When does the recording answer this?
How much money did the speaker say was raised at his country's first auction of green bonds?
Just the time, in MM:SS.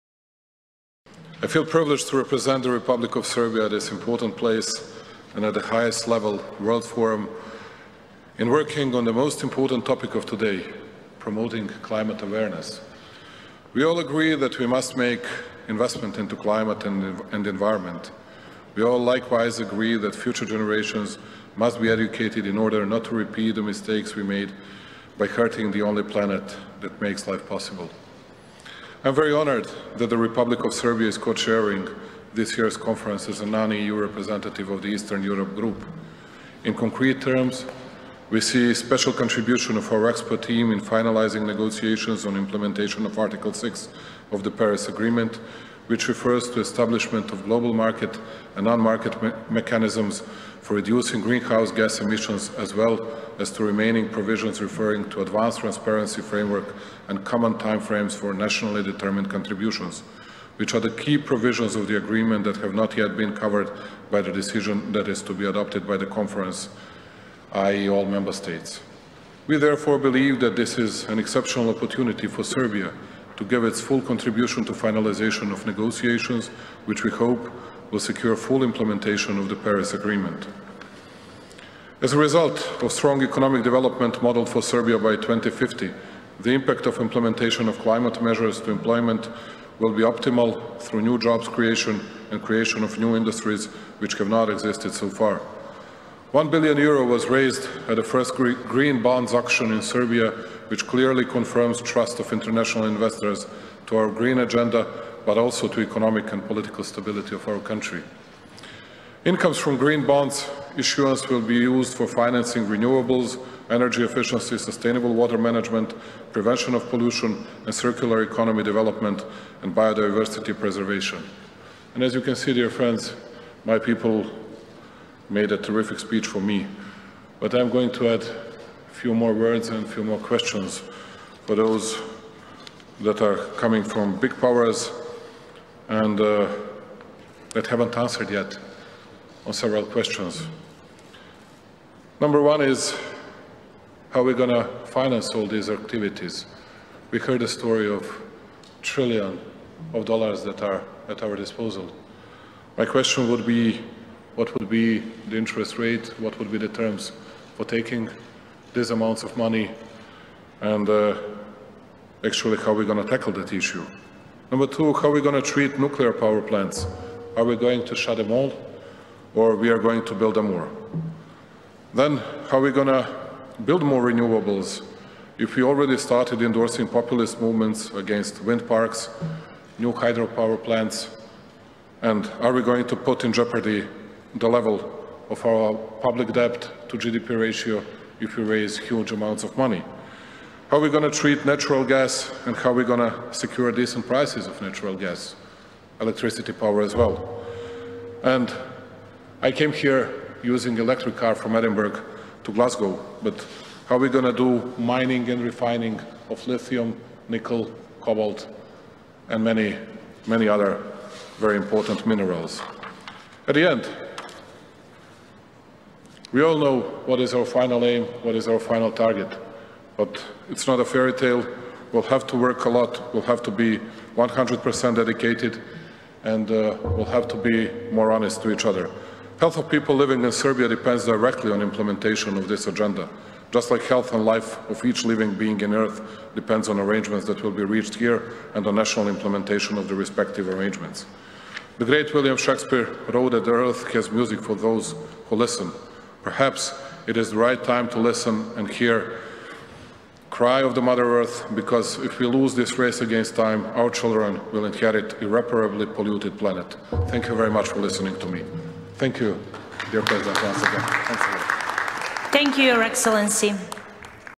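01:36.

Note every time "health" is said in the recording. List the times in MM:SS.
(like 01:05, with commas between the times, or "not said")
03:49, 03:53.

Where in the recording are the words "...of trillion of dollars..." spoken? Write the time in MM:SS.
02:27.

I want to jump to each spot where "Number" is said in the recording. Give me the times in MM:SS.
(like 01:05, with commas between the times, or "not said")
02:22, 02:44.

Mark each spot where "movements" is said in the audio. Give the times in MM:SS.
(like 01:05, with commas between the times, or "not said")
02:57.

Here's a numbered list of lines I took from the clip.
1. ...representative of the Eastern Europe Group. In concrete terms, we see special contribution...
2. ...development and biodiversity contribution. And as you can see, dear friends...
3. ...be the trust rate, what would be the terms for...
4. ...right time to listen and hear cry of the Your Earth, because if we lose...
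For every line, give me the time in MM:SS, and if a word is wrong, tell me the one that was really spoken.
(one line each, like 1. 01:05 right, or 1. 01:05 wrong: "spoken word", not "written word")
1. 00:33 right
2. 01:58 wrong: "preservation", not "contribution"
3. 02:34 wrong: "interest", not "trust"
4. 04:07 wrong: "Mother", not "Your".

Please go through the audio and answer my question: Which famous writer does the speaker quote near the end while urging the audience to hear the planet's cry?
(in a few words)
William Shakespeare.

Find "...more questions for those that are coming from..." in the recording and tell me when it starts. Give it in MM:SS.
02:10.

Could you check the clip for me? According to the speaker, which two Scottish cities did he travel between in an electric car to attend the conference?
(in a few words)
Edinburgh to Glasgow.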